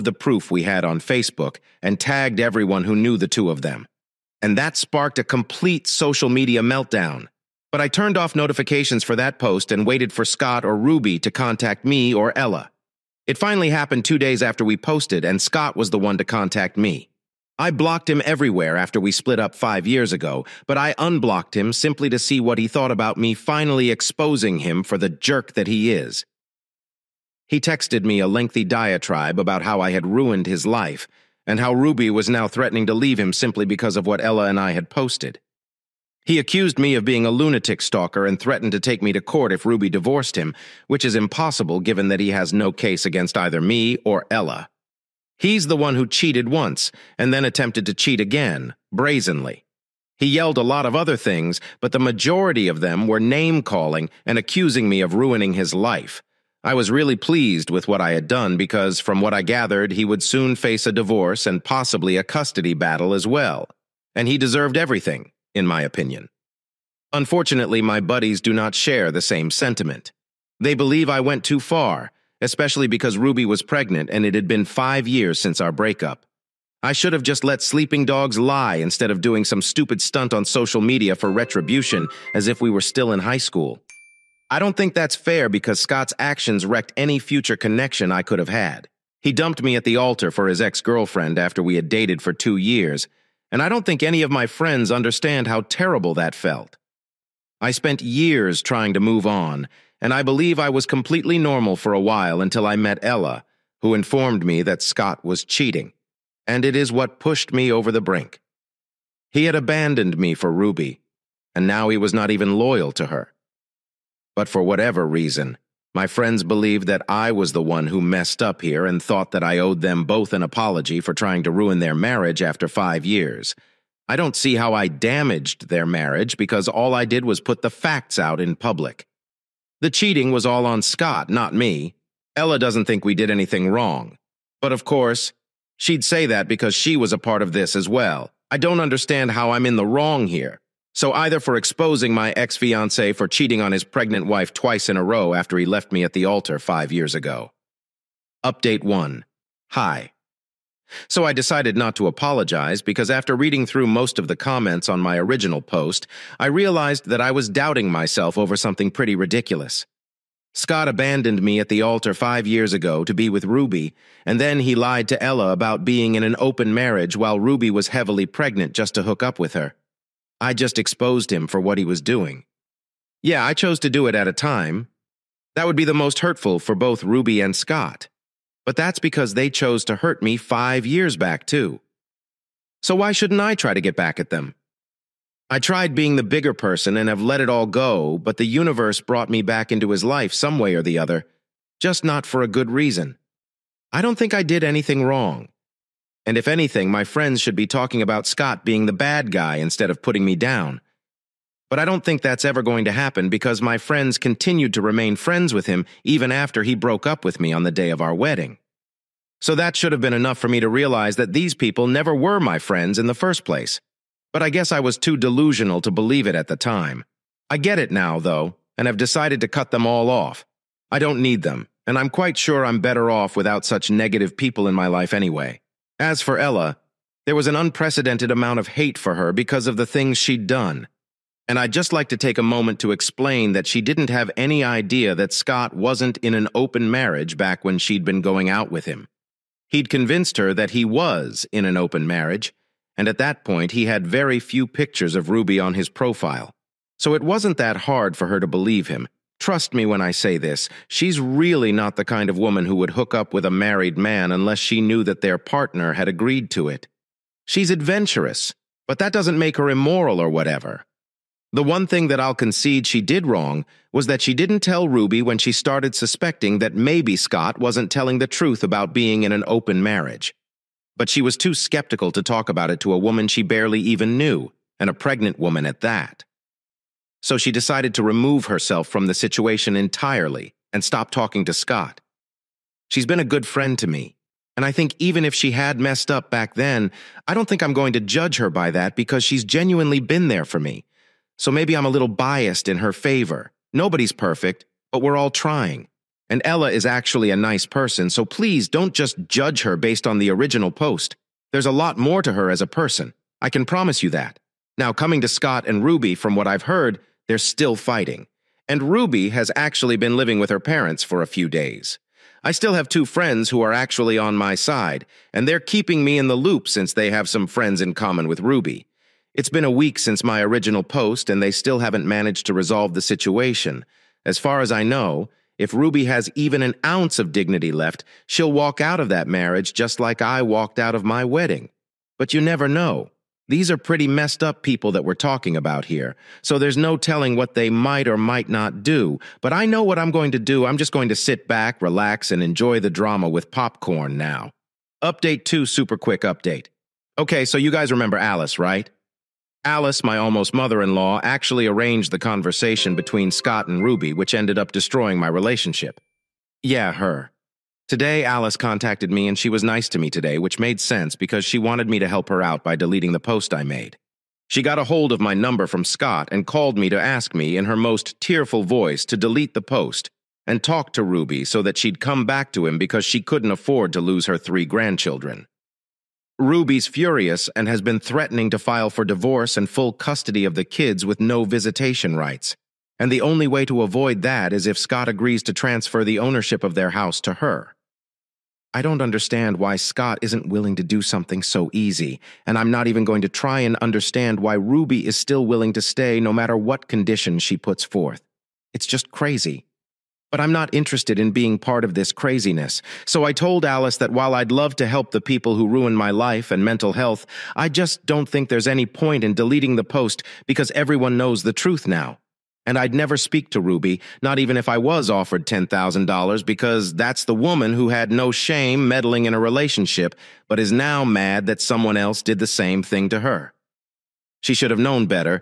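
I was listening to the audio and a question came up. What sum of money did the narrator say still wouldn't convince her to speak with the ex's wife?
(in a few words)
$10,000.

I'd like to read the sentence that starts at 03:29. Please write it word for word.
So that should have been enough for me to realize that these people never were my friends in the first place.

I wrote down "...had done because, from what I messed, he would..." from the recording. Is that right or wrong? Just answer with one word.
wrong.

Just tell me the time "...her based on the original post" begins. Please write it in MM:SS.
04:59.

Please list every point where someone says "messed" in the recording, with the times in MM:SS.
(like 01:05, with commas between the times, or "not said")
01:58, 04:45, 05:34.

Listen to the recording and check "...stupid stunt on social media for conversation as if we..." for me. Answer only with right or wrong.
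wrong.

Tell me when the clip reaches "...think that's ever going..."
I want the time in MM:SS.
03:22.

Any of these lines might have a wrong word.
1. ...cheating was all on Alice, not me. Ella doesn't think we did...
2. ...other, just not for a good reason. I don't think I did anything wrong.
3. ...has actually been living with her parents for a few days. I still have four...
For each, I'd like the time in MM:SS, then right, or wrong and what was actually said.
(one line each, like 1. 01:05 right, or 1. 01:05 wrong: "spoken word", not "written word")
1. 02:09 wrong: "Scott", not "Alice"
2. 03:10 right
3. 05:09 wrong: "two", not "four".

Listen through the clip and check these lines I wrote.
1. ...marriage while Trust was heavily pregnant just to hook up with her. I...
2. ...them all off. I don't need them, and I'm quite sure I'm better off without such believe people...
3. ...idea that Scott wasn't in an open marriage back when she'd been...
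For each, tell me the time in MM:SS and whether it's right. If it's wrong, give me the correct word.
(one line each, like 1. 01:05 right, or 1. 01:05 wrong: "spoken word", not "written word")
1. 02:46 wrong: "Ruby", not "Trust"
2. 03:39 wrong: "negative", not "believe"
3. 03:54 right.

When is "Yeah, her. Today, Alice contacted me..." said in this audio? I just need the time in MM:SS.
05:56.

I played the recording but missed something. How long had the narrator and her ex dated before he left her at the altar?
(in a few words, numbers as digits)
2 years.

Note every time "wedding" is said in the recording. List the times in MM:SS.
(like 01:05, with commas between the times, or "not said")
03:28, 05:31.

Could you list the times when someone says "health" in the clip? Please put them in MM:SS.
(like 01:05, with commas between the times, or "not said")
06:46.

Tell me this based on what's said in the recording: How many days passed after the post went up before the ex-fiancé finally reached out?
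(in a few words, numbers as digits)
2.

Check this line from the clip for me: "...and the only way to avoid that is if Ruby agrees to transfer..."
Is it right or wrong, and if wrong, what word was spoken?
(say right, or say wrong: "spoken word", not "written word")
wrong: "Scott", not "Ruby".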